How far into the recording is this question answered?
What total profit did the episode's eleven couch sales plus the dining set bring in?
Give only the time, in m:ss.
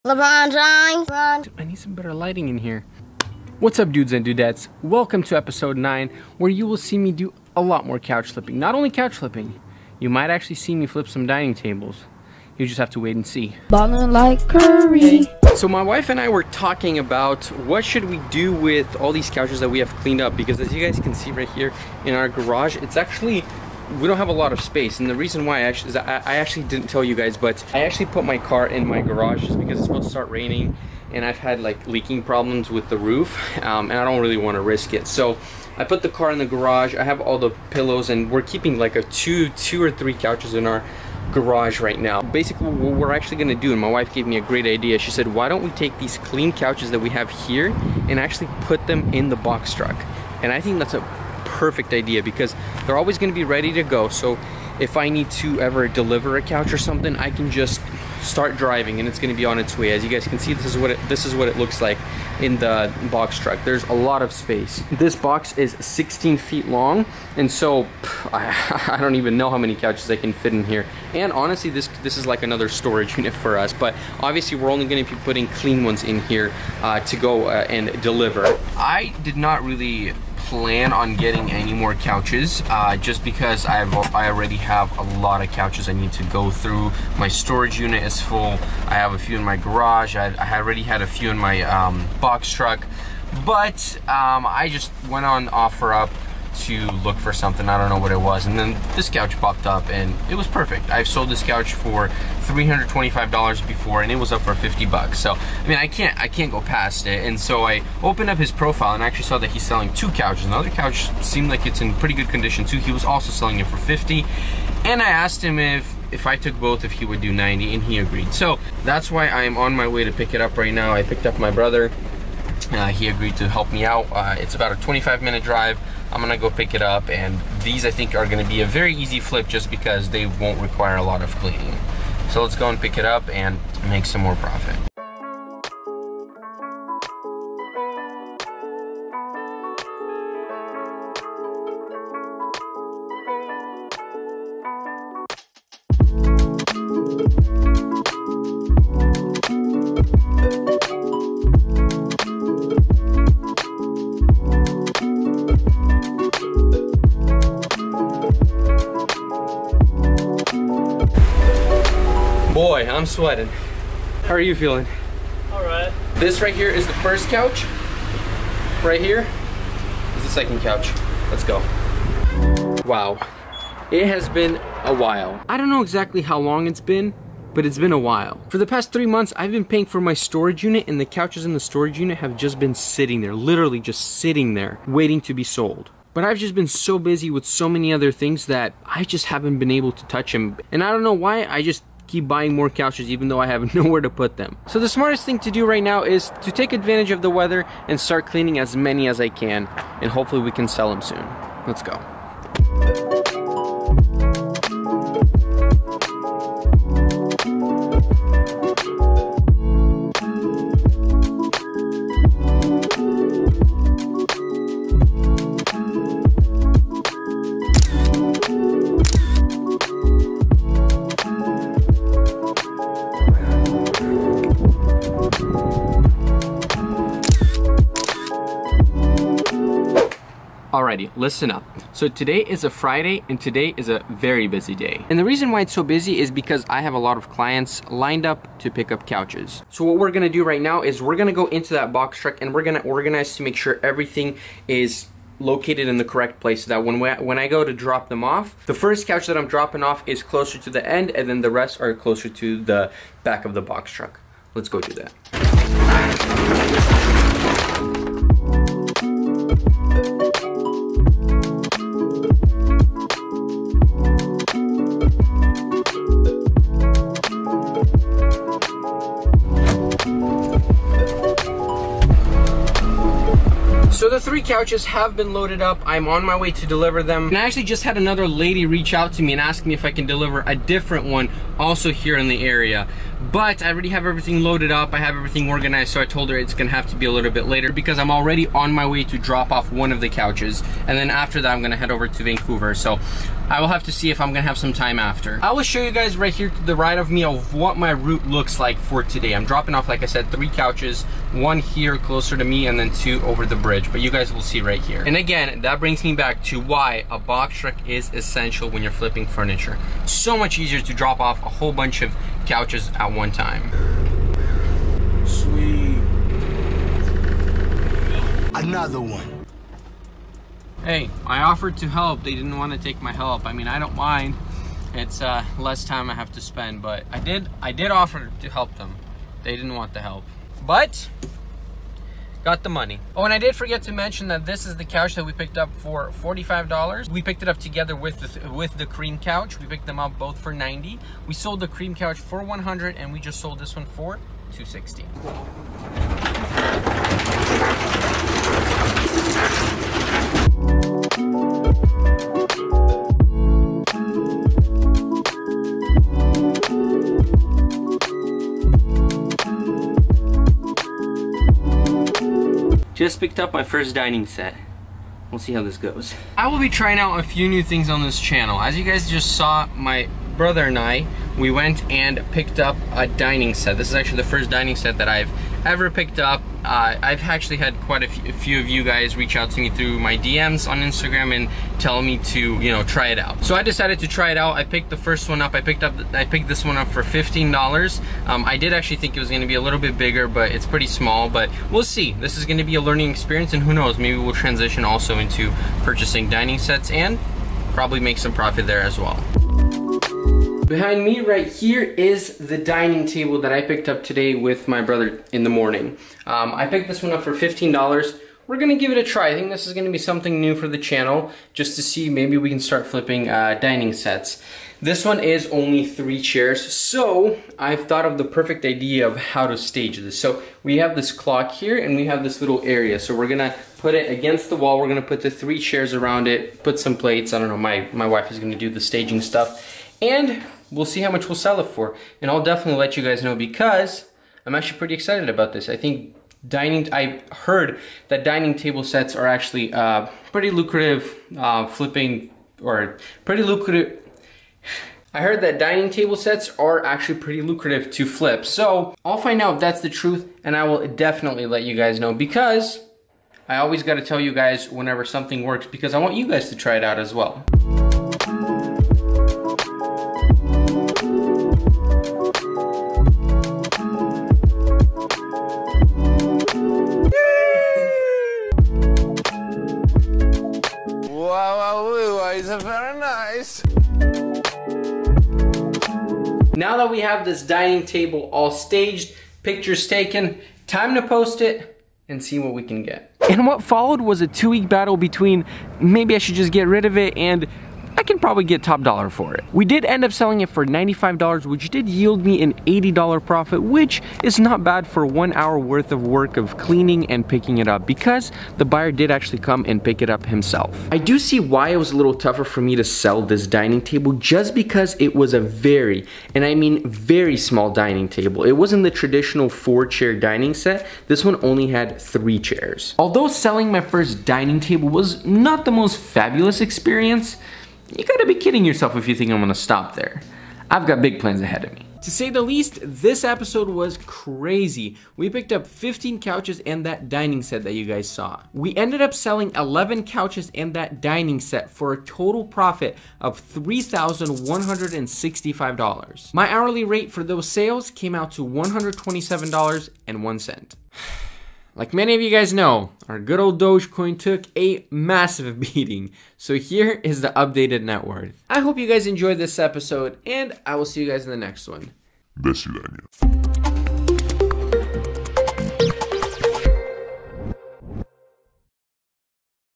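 8:53.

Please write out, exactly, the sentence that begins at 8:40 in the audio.
I've got big plans ahead of me.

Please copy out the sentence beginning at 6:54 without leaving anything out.
This one is only three chairs, so I've thought of the perfect idea of how to stage this.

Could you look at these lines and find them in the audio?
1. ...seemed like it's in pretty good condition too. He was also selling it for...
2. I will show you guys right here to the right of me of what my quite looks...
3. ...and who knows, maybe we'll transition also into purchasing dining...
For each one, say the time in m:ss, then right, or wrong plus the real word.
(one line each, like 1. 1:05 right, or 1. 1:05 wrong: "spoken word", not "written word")
1. 1:51 right
2. 4:55 wrong: "route", not "quite"
3. 6:33 right.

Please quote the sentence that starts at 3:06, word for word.
But I've just been so busy with so many other things that I just haven't been able to touch them.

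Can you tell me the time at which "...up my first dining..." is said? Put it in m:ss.
6:03.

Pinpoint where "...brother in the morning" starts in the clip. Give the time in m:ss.
6:44.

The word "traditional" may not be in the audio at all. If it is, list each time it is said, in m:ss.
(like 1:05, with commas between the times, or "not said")
8:28.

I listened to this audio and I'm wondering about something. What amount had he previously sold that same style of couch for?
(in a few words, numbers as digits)
$325.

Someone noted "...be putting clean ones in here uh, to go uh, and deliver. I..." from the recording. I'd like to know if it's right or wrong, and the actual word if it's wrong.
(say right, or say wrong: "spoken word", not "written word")
right.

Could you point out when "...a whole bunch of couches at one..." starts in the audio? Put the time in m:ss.
5:11.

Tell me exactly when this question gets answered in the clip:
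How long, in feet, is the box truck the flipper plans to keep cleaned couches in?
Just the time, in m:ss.
1:05.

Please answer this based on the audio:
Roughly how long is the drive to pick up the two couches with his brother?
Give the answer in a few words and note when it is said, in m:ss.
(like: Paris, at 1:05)
25 minutes, at 2:04.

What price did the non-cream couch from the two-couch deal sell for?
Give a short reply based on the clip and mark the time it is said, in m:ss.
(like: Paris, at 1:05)
$260, at 5:44.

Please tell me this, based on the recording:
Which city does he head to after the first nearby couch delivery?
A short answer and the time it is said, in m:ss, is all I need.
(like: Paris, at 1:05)
Vancouver, at 4:52.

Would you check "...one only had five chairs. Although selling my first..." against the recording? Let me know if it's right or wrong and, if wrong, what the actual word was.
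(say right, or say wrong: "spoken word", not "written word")
wrong: "three", not "five".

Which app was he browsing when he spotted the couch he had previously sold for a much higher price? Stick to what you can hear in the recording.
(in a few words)
OfferUp.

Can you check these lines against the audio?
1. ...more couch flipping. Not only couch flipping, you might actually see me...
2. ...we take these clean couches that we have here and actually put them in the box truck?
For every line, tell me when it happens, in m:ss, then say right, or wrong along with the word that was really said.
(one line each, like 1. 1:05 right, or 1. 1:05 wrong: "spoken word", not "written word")
1. 0:07 right
2. 0:45 right.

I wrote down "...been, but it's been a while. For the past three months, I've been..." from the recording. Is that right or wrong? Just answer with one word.
right.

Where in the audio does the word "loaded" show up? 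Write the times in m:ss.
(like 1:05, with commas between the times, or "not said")
4:35, 4:44.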